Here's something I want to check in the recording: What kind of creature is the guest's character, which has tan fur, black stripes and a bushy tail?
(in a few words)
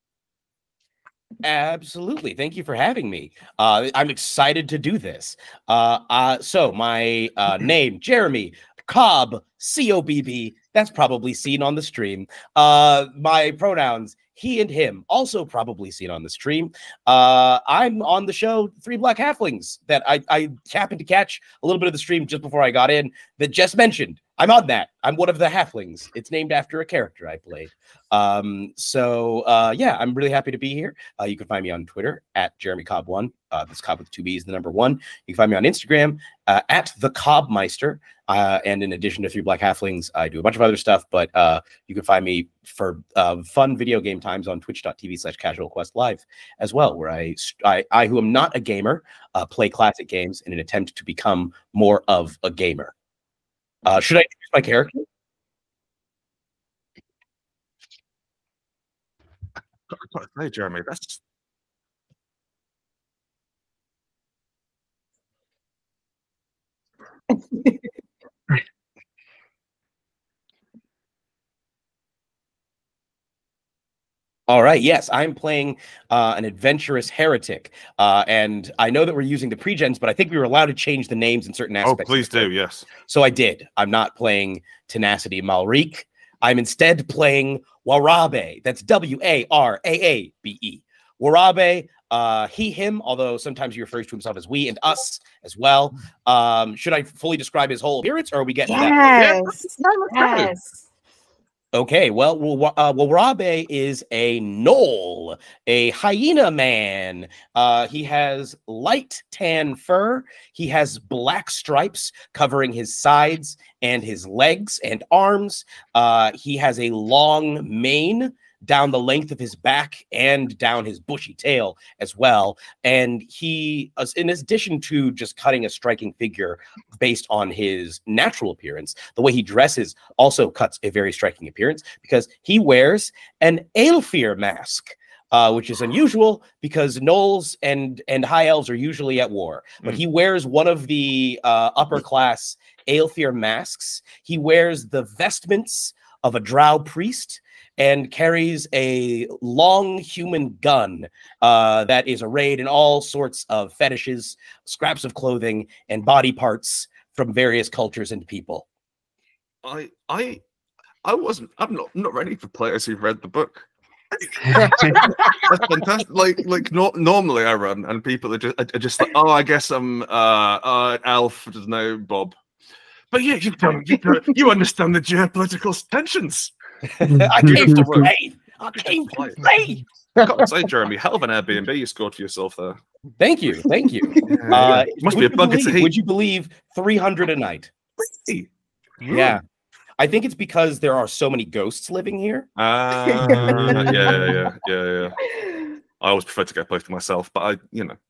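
gnoll.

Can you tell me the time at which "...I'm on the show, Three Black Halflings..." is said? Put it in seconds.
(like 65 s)
17 s.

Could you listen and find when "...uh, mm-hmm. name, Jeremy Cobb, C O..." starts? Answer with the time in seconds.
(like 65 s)
7 s.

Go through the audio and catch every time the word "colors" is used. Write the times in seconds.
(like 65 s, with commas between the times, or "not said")
not said.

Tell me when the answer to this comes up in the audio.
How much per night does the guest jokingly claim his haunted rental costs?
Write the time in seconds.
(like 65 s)
186 s.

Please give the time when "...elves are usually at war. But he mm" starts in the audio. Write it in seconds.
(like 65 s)
138 s.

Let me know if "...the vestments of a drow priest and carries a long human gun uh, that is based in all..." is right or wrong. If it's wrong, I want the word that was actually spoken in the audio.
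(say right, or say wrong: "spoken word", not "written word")
wrong: "arrayed", not "based".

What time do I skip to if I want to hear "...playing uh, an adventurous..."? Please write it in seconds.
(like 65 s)
75 s.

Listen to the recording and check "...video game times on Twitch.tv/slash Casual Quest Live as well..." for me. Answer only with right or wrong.
right.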